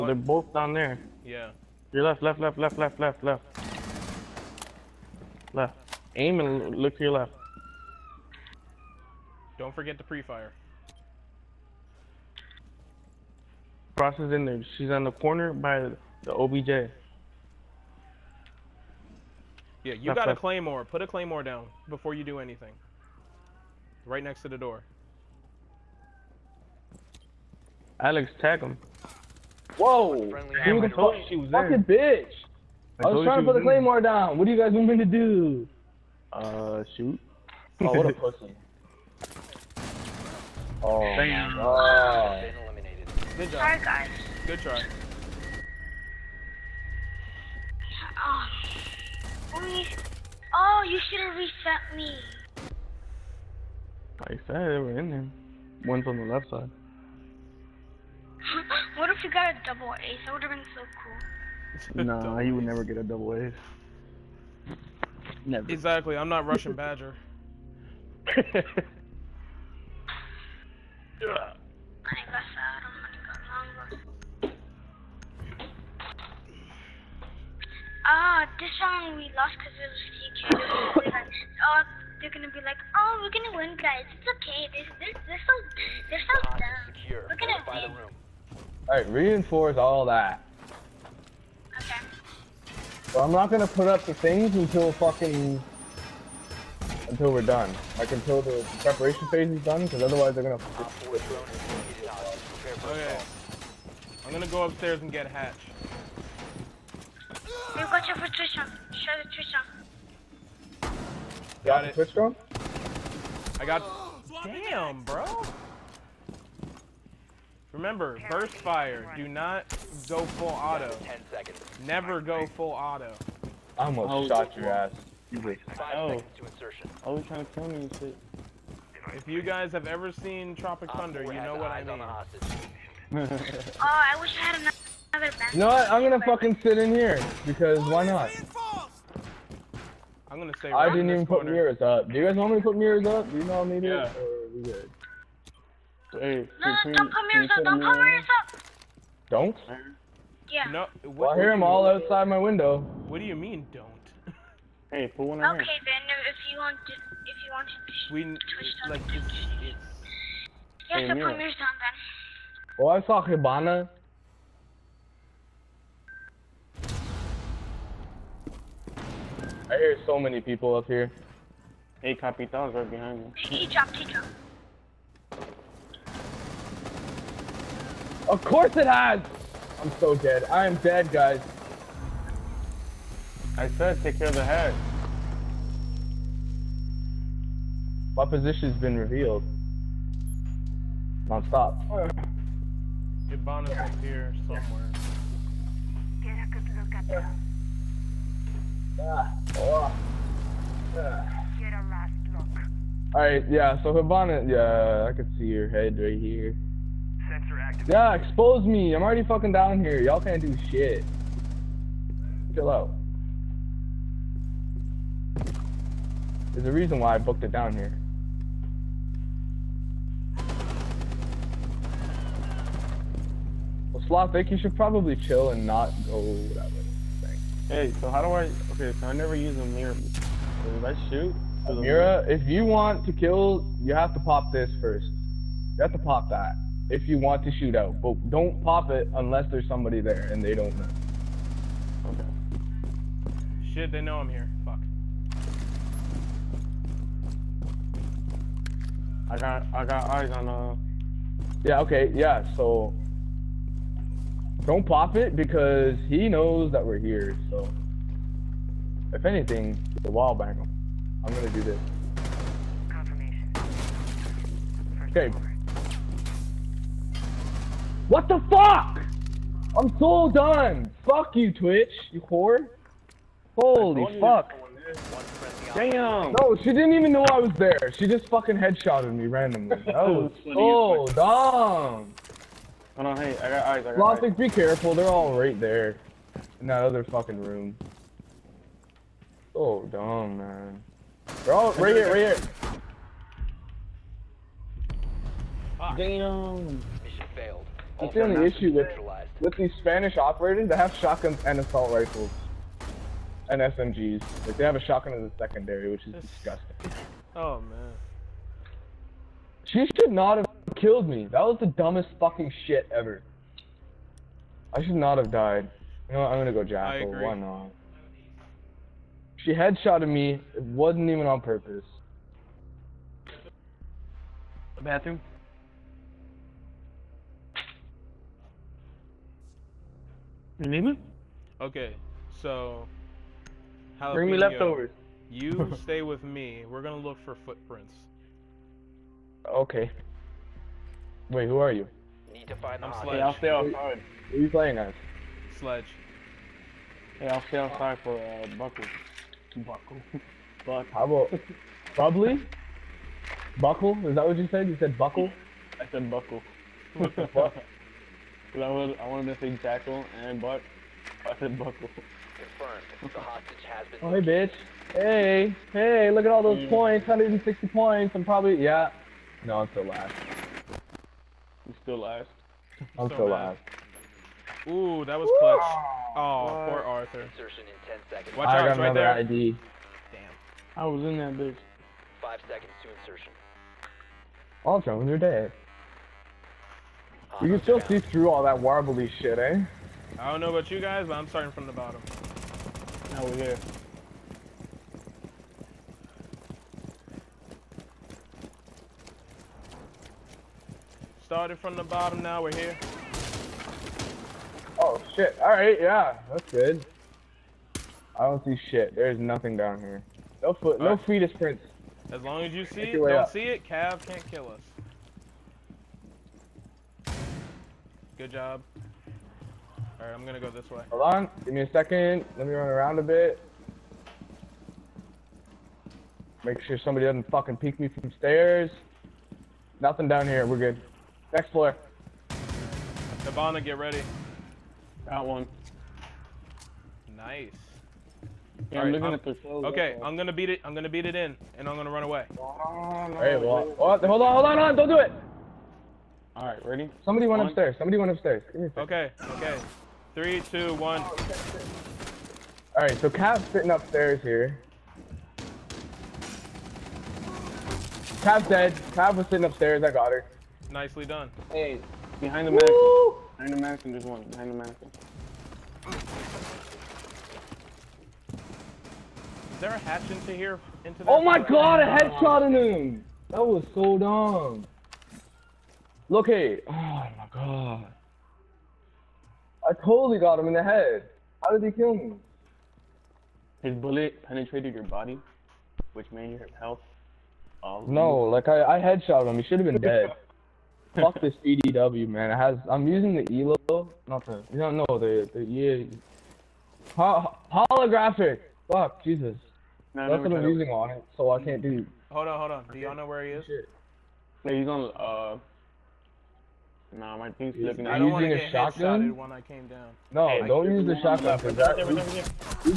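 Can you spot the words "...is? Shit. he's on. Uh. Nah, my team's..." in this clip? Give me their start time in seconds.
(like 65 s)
503 s.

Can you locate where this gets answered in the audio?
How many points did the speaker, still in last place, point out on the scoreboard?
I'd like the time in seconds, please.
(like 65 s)
367 s.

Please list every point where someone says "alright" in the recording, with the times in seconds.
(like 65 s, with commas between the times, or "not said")
88 s, 203 s, 405 s, 419 s.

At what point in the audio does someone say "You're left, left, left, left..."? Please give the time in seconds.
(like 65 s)
1 s.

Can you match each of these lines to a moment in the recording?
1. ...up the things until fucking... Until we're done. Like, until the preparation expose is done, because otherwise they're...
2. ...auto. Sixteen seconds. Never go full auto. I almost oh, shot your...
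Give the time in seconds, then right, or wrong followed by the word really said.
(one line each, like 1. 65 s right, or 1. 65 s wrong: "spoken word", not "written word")
1. 93 s wrong: "phase", not "expose"
2. 120 s wrong: "Ten", not "Sixteen".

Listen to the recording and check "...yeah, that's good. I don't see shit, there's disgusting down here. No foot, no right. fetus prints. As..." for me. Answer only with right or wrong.
wrong.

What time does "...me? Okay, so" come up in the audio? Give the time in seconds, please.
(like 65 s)
330 s.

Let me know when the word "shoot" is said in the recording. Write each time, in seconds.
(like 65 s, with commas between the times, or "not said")
36 s, 231 s, 237 s.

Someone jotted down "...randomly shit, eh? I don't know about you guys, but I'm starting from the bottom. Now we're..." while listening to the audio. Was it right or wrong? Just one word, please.
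wrong.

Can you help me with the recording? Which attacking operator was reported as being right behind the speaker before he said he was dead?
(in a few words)
Capitão.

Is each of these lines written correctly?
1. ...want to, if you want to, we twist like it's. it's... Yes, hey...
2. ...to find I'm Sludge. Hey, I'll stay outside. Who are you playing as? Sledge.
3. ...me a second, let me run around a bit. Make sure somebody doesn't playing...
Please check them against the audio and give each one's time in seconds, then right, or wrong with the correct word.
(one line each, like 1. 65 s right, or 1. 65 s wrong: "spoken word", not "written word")
1. 156 s right
2. 342 s right
3. 421 s wrong: "fucking", not "playing".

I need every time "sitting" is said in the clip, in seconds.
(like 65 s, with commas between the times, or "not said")
453 s, 459 s.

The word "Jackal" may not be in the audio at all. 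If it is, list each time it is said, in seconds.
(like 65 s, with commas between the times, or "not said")
316 s, 359 s.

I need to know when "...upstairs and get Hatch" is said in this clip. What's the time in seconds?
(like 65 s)
104 s.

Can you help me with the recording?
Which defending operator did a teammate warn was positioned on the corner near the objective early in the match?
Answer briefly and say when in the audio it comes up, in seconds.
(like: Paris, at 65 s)
Frost, at 13 s.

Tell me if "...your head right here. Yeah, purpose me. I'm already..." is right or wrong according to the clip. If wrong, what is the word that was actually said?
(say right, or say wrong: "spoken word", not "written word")
wrong: "expose", not "purpose".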